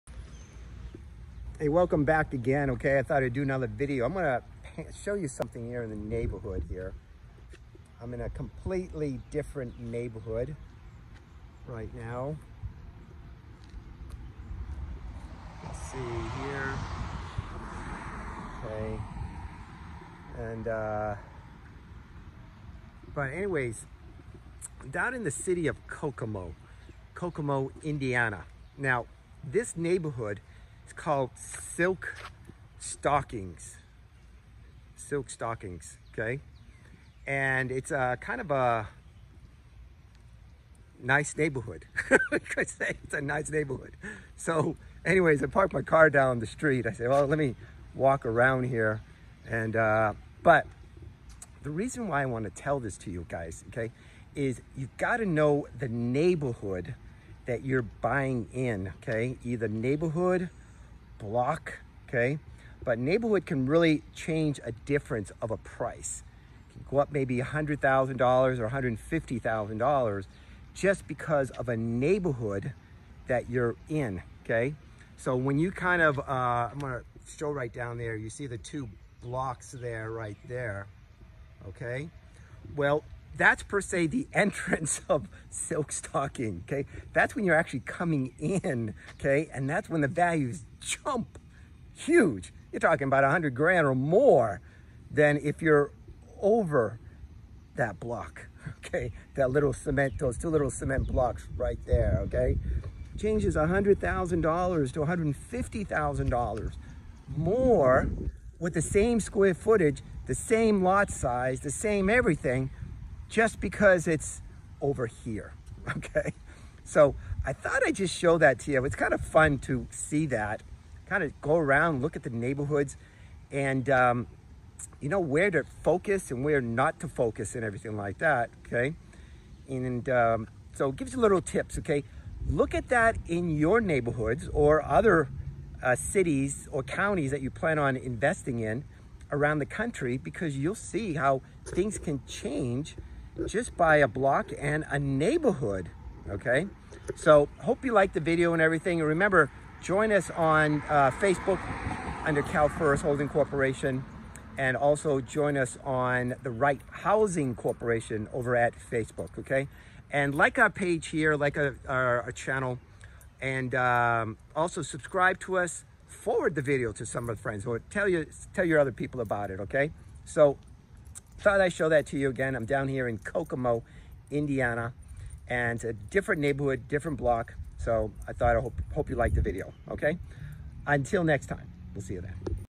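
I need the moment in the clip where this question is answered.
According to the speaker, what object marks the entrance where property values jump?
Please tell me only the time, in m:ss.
1:40.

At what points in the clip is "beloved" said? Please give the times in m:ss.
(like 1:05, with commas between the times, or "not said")
not said.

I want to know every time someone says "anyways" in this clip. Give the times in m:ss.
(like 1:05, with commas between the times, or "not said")
0:23, 0:45.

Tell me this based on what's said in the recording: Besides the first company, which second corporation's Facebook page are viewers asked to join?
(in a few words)
Right Housing Corporation.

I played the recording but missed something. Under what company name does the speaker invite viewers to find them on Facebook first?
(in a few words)
CalFirst Holding Corporation.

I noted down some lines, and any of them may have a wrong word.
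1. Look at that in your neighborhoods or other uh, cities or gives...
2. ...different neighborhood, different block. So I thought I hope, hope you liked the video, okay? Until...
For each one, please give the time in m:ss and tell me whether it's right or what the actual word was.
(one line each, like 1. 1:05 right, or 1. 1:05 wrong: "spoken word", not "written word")
1. 2:12 wrong: "counties", not "gives"
2. 2:55 right.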